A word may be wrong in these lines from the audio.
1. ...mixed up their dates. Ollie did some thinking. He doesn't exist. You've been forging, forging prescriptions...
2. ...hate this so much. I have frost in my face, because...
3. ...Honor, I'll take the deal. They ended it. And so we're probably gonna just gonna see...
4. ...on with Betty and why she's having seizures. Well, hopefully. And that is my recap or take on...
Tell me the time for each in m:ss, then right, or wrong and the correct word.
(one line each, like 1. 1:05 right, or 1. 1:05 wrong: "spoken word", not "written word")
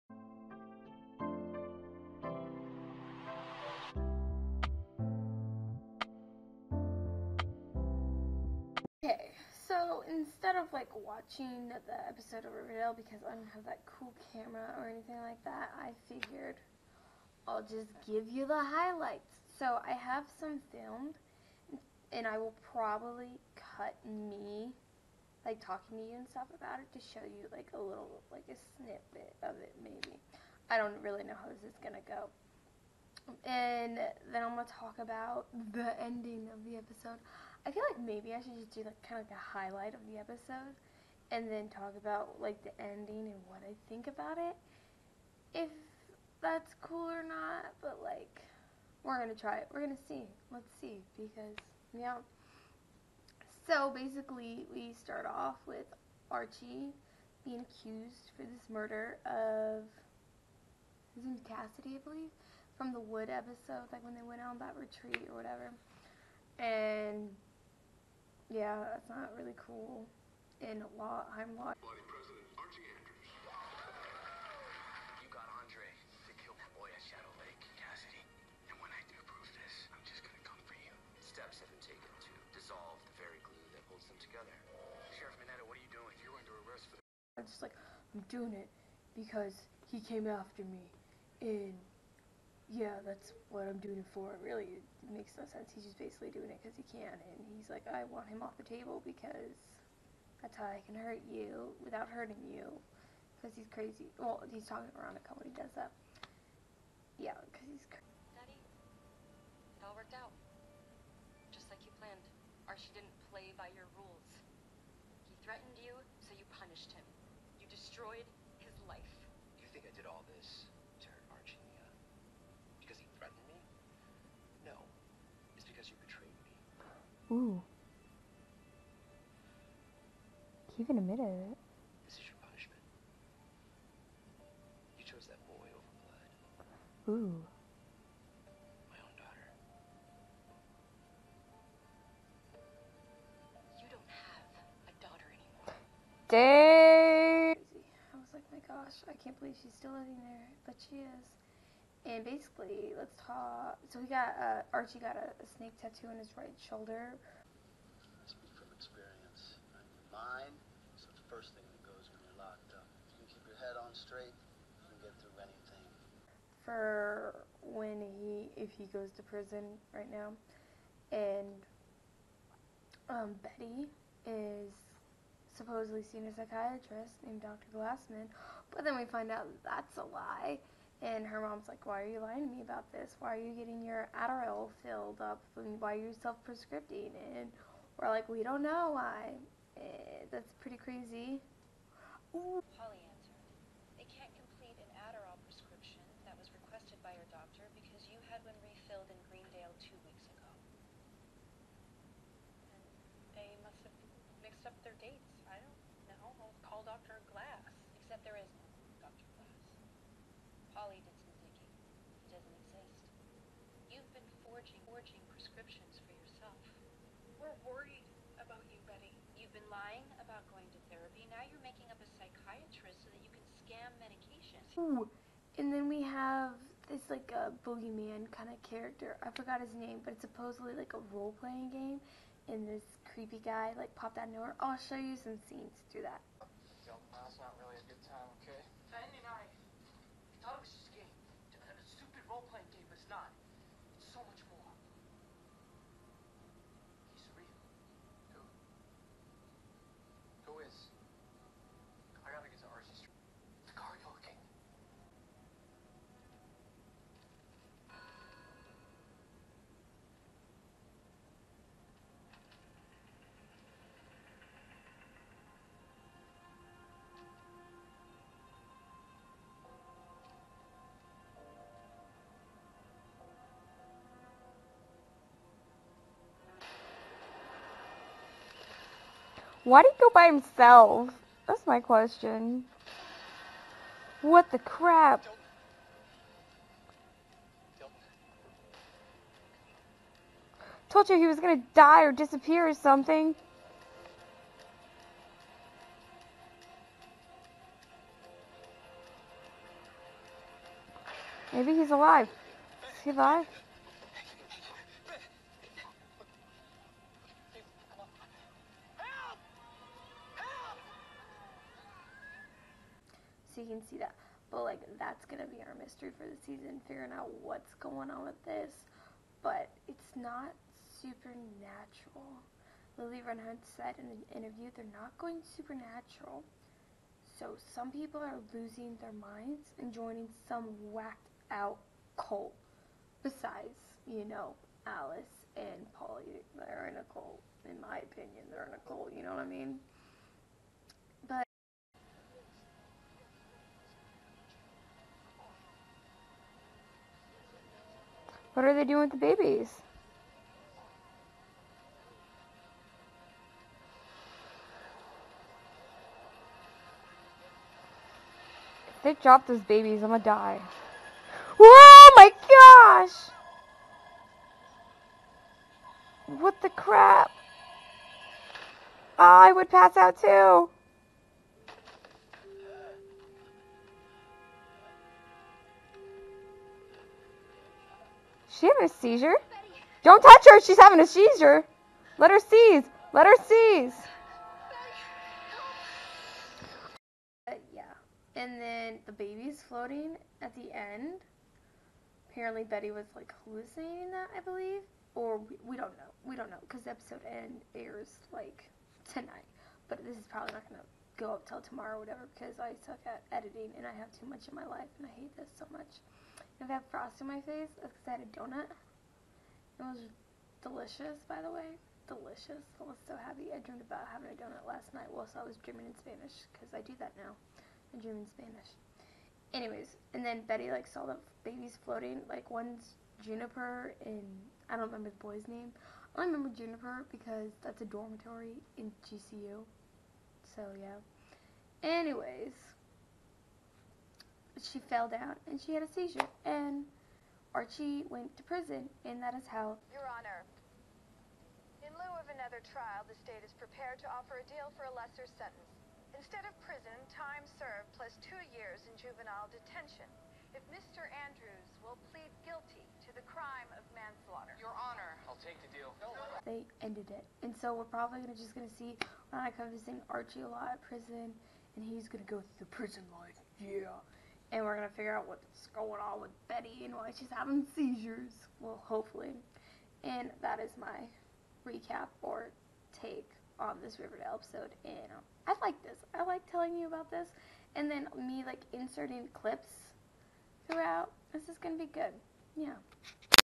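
1. 3:24 right
2. 6:45 right
3. 7:34 right
4. 7:46 right.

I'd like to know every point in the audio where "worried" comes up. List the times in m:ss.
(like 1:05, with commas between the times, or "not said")
3:37.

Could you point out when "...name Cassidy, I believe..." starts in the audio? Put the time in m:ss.
1:01.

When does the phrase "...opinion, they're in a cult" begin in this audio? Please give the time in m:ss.
5:37.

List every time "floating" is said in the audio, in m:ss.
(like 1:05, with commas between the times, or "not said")
6:29, 7:01.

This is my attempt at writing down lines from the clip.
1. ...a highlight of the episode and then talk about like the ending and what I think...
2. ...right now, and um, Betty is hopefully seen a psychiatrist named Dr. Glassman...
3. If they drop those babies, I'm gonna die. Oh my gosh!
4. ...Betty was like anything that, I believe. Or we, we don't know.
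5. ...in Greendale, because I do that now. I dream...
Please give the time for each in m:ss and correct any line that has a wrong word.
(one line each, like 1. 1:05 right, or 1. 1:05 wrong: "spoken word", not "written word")
1. 0:39 right
2. 2:49 wrong: "supposedly", not "hopefully"
3. 5:58 right
4. 6:32 wrong: "hallucinating", not "anything"
5. 6:55 wrong: "Spanish", not "Greendale".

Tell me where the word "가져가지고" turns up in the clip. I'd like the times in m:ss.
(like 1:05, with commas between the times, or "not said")
4:04.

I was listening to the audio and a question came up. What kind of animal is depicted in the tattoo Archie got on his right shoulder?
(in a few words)
Snake.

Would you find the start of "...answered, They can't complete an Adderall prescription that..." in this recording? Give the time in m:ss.
3:13.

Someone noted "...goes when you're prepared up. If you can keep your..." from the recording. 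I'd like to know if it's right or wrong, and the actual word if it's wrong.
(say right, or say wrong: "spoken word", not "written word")
wrong: "locked", not "prepared".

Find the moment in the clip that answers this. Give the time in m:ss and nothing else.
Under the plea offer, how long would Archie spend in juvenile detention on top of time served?
7:28.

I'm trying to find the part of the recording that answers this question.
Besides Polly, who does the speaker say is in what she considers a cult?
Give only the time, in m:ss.
5:34.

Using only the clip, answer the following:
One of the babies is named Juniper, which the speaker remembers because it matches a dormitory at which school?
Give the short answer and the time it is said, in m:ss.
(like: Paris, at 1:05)
GCU, at 7:09.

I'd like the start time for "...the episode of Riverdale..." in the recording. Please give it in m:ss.
0:11.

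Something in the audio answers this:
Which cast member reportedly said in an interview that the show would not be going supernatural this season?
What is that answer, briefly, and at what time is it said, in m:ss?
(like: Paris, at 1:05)
Lili Reinhart, at 5:22.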